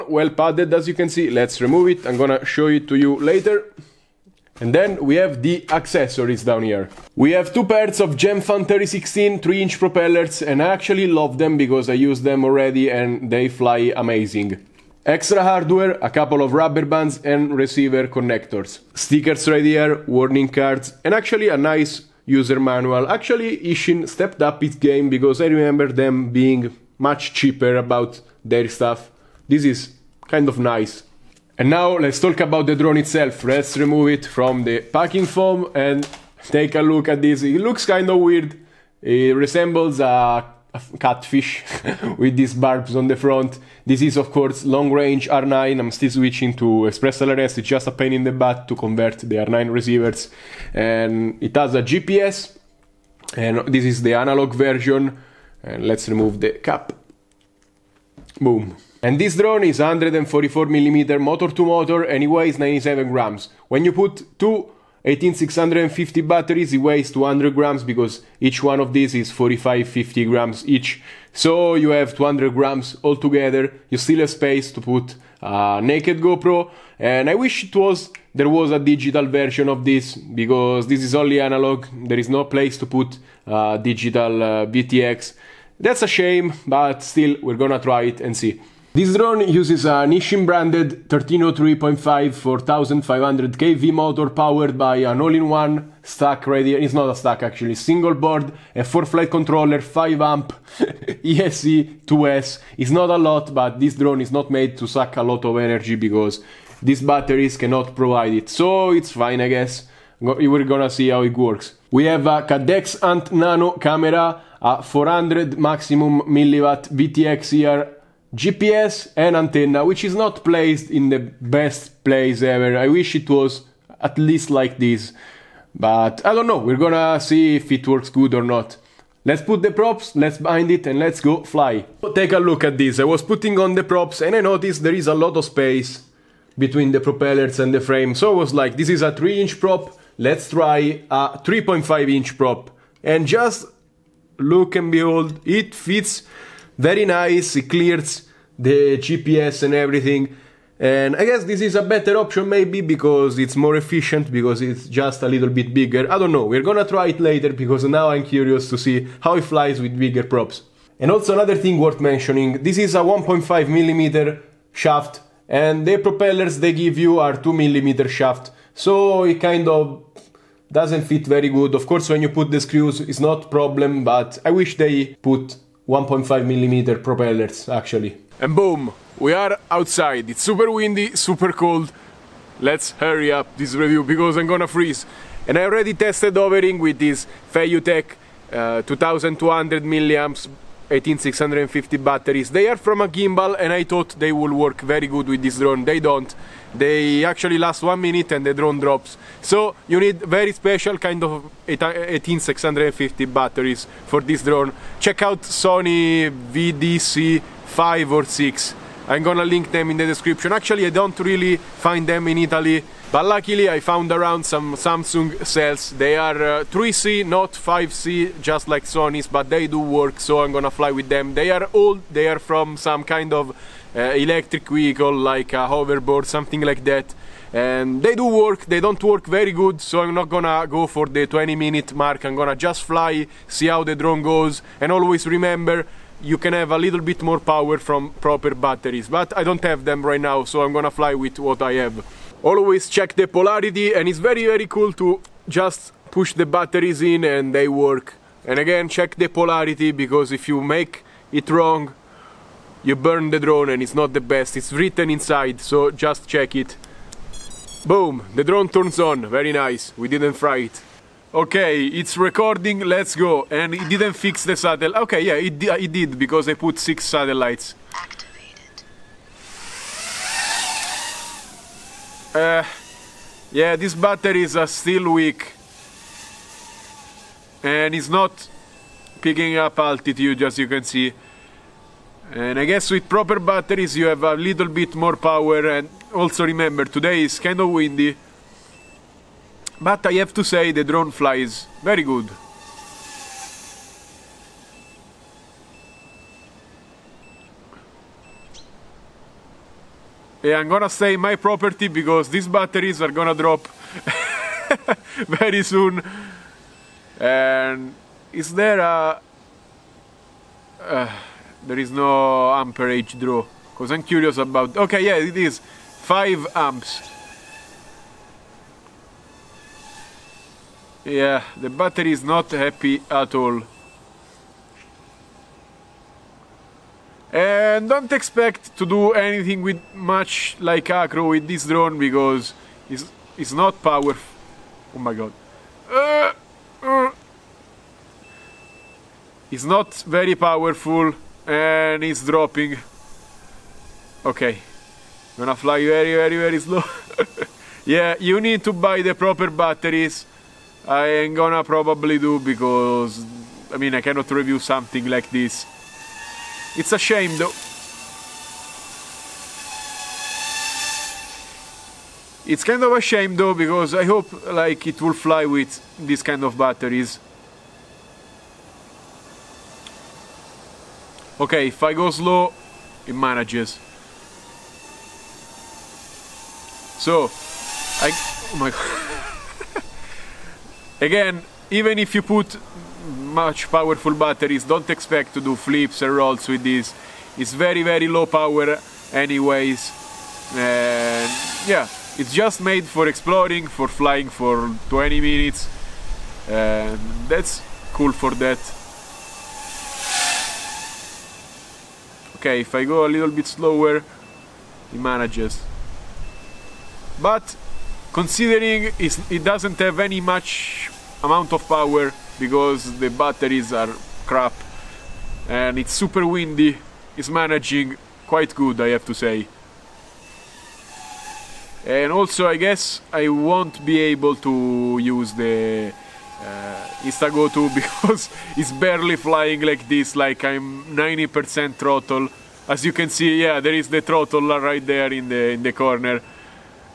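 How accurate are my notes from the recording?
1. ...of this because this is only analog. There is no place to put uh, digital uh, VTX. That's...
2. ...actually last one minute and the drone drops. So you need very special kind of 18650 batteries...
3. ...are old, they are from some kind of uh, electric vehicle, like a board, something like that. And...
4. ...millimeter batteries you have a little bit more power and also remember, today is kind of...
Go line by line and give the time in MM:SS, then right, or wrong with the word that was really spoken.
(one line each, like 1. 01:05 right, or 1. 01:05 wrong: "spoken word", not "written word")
1. 01:19 right
2. 03:17 right
3. 03:41 wrong: "hoverboard", not "board"
4. 04:43 wrong: "proper", not "millimeter".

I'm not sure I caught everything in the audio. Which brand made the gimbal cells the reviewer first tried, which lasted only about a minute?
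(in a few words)
FeiyuTech.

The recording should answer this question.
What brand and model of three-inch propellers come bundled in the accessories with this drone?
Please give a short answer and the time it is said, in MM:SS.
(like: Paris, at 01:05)
Gemfan 3016, at 00:08.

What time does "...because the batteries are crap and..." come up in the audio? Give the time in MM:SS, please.
06:52.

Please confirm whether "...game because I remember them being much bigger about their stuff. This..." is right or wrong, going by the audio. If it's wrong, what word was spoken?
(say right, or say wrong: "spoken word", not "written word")
wrong: "cheaper", not "bigger".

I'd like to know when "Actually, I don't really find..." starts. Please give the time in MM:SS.
03:30.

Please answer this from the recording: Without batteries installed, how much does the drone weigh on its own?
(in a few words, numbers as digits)
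97 grams.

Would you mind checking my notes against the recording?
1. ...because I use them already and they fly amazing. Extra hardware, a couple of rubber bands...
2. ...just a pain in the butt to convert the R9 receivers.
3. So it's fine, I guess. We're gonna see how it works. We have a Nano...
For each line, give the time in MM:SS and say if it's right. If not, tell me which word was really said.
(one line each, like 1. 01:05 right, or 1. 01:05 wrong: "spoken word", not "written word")
1. 00:11 right
2. 00:47 right
3. 01:48 wrong: "Caddx", not "Nano".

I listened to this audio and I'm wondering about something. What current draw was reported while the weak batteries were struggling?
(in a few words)
5 amps.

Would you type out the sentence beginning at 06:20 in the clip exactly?
Again, even if you put much powerful batteries, don't expect to do flips and rolls with this.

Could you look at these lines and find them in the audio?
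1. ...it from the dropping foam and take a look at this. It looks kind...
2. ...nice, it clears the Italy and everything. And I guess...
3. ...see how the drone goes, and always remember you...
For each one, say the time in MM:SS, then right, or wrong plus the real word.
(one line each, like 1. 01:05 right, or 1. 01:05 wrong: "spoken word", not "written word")
1. 00:34 wrong: "packing", not "dropping"
2. 02:27 wrong: "GPS", not "Italy"
3. 03:53 right.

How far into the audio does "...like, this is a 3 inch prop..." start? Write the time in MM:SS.
02:18.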